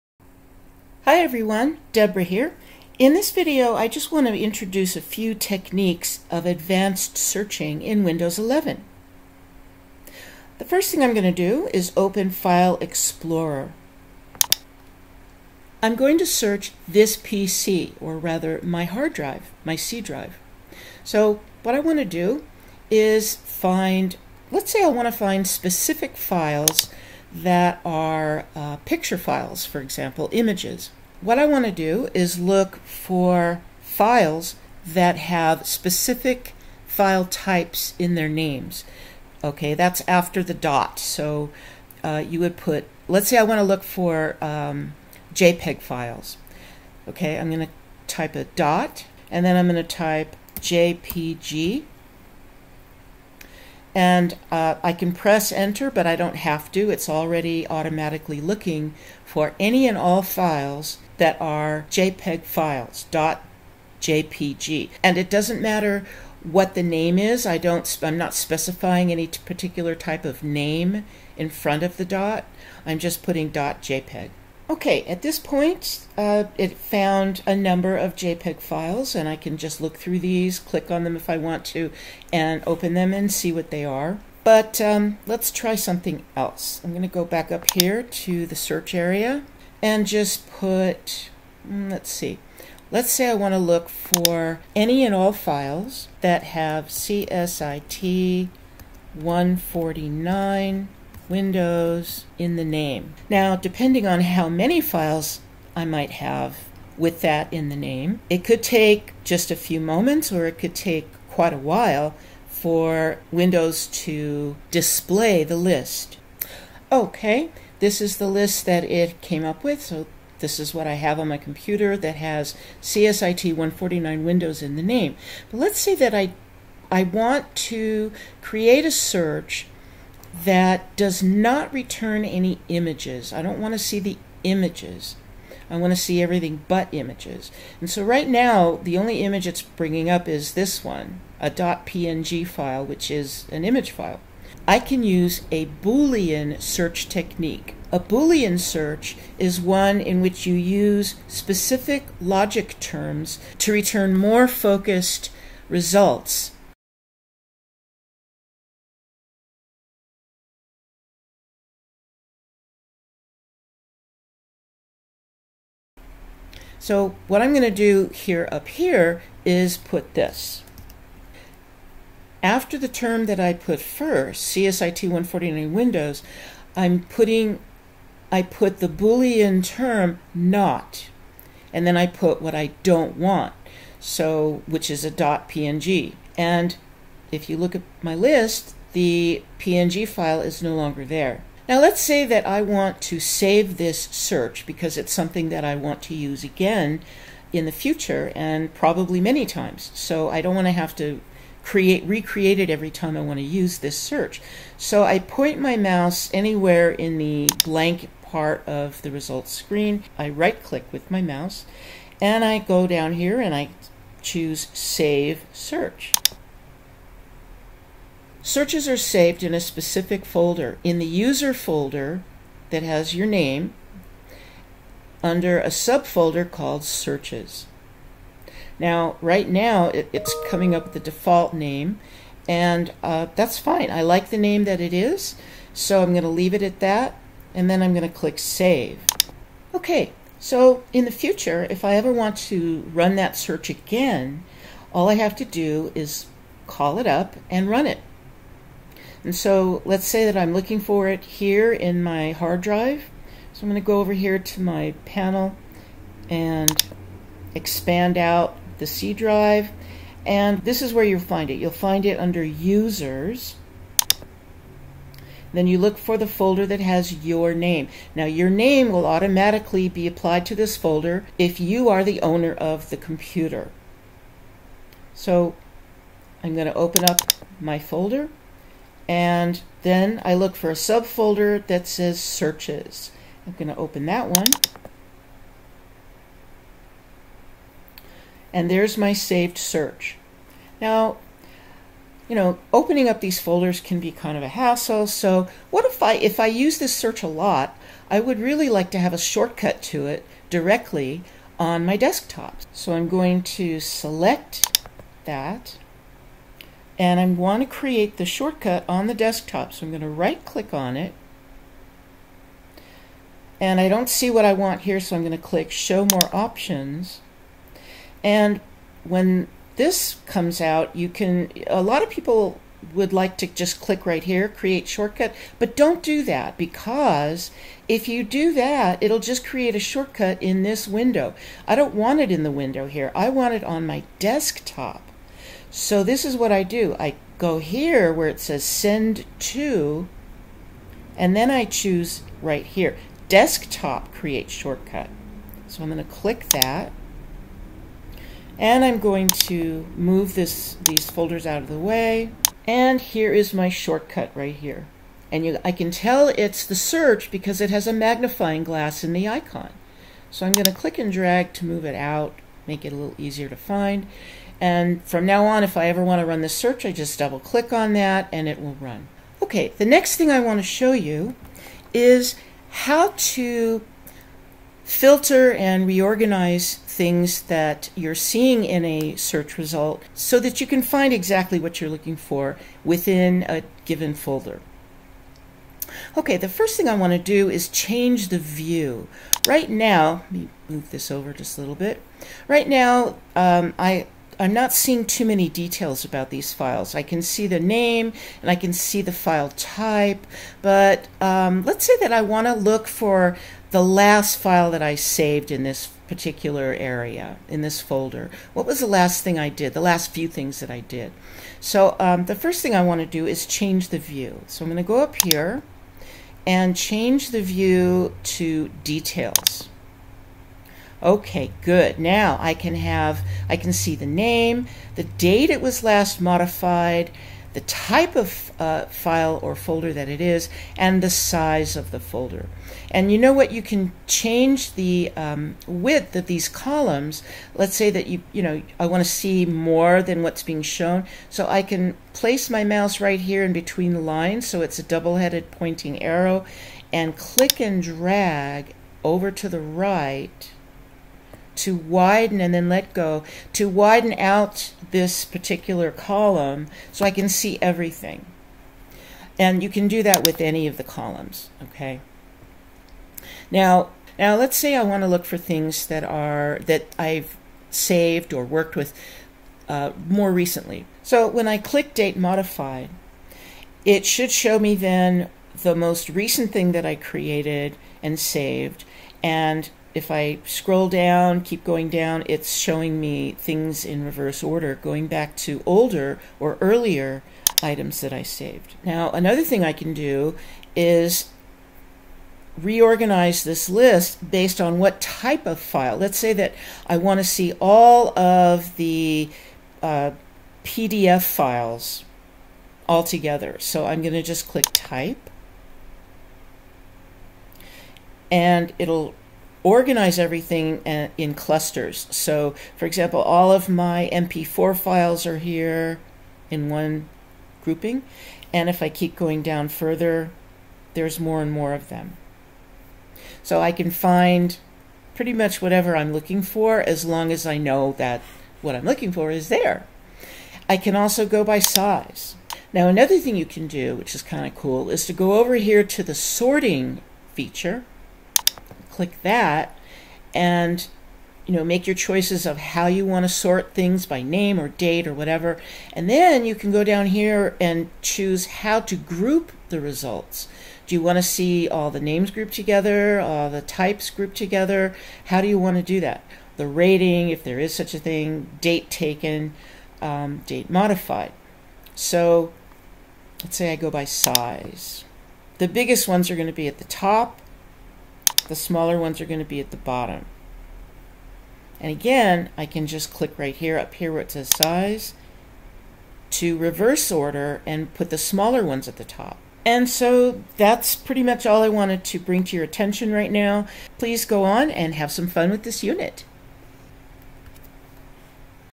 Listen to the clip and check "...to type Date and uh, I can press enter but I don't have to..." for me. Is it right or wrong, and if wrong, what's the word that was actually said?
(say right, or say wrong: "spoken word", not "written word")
wrong: "JPG", not "Date".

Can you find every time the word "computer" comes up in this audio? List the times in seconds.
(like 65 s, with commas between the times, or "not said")
121 s, 272 s.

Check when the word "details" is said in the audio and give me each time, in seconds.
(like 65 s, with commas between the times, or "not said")
395 s, 418 s.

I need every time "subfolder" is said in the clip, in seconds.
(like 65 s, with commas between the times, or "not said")
225 s, 280 s.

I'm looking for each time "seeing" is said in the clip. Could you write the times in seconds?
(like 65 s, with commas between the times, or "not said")
378 s, 394 s.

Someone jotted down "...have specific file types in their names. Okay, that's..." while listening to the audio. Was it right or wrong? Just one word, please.
right.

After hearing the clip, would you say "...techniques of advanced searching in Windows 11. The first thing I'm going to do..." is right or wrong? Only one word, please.
right.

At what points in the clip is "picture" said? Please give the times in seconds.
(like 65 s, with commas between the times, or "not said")
28 s.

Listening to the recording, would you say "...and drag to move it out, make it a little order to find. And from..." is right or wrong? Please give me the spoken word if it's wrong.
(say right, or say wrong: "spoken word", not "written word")
wrong: "easier", not "order".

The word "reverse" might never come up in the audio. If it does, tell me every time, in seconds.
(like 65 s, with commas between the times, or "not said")
484 s, 576 s.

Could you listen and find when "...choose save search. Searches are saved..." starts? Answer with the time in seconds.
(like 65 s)
214 s.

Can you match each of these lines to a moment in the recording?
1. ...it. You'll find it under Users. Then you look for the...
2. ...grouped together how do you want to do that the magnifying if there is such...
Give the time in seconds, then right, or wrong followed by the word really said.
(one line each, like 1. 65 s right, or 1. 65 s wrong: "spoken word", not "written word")
1. 261 s right
2. 554 s wrong: "rating", not "magnifying".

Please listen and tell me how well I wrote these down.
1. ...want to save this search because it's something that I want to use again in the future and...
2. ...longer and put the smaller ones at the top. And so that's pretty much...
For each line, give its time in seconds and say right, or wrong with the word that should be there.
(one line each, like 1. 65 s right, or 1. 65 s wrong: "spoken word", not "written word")
1. 192 s right
2. 577 s wrong: "order", not "longer".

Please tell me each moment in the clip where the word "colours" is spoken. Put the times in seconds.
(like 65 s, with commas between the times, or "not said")
not said.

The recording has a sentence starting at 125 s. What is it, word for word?
But let's say that I, I want to create a search that does not return any images.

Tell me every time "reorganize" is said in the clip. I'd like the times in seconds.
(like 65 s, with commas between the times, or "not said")
375 s, 492 s.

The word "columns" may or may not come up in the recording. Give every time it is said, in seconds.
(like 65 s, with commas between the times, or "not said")
436 s, 455 s, 460 s.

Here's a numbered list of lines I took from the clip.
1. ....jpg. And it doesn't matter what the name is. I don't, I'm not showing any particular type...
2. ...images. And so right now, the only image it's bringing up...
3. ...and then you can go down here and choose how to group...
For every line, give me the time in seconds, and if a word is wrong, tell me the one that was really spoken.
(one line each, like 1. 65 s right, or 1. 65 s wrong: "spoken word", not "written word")
1. 64 s wrong: "specifying", not "showing"
2. 136 s right
3. 545 s right.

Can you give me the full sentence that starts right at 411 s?
So um, the first thing I want to do is change the view.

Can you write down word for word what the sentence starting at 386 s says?
Okay, the first thing I want to do is change the view.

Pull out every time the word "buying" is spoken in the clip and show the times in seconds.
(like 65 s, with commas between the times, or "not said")
not said.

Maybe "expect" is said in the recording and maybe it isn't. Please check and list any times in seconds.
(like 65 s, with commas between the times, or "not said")
not said.